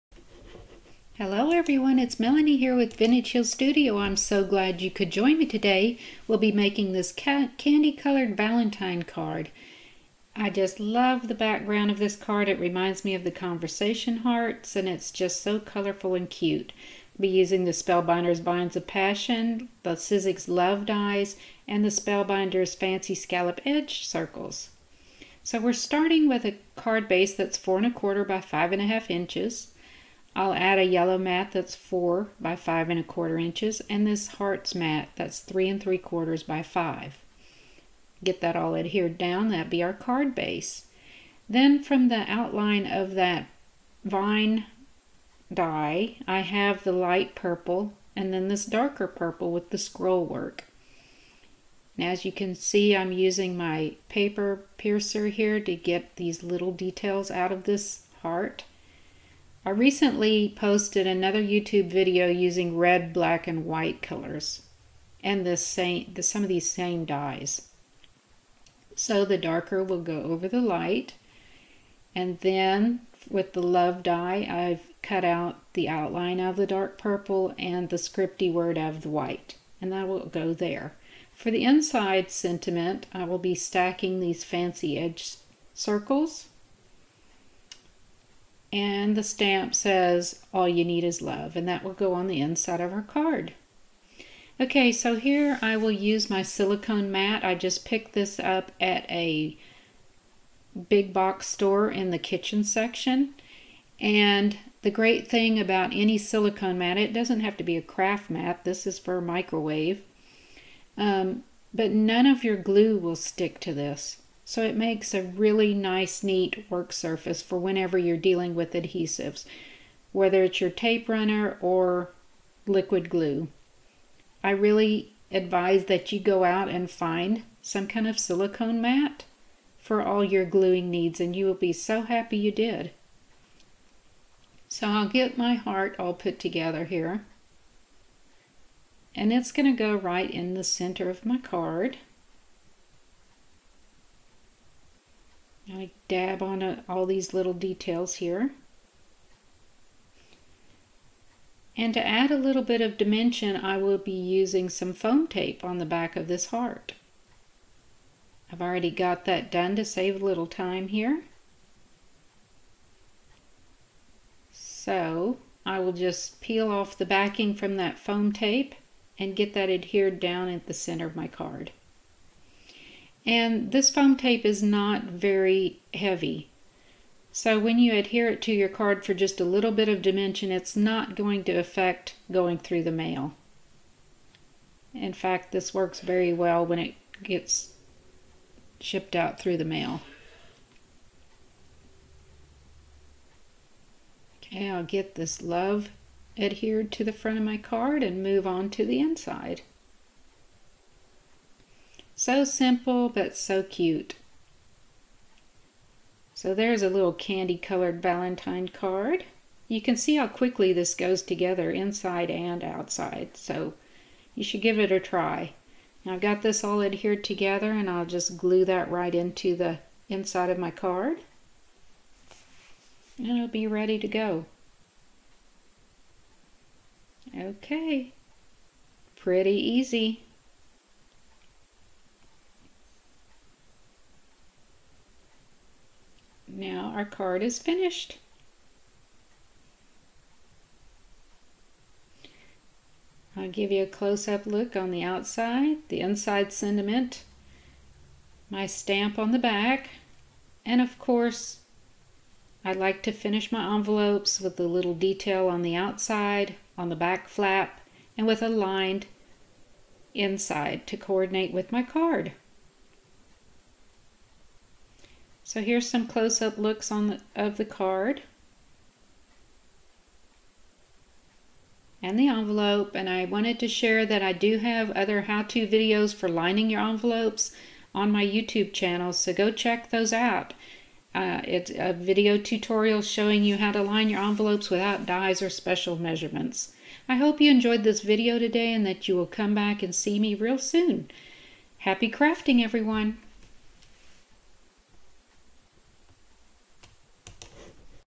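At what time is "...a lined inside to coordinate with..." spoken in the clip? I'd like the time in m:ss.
4:18.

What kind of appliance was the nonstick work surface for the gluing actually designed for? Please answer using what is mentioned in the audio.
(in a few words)
microwave.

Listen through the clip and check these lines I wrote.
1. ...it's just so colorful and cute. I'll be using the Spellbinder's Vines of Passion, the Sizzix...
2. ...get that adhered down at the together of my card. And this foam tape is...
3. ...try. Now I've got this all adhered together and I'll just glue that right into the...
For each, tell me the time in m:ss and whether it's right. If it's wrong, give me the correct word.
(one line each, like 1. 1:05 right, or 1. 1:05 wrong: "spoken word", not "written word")
1. 0:14 right
2. 2:49 wrong: "center", not "together"
3. 3:34 right.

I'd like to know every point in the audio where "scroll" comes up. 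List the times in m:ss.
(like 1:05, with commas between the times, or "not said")
0:49.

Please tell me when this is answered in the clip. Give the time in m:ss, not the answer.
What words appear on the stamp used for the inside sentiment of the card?
1:30.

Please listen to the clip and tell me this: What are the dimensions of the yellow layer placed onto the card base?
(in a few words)
4 by 5 1/4 inches.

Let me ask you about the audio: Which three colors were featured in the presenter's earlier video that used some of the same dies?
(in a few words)
red, black, and white.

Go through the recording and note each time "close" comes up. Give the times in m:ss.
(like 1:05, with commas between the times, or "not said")
4:03, 4:26.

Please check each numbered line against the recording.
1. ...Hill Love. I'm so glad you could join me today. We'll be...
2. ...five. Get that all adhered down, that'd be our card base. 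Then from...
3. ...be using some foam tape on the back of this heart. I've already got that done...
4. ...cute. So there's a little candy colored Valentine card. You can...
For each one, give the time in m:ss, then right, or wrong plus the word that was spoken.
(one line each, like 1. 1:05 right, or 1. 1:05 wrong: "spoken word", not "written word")
1. 0:03 wrong: "Studio", not "Love"
2. 0:36 right
3. 2:33 right
4. 3:23 right.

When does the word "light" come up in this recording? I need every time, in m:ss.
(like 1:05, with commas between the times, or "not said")
0:46, 1:10.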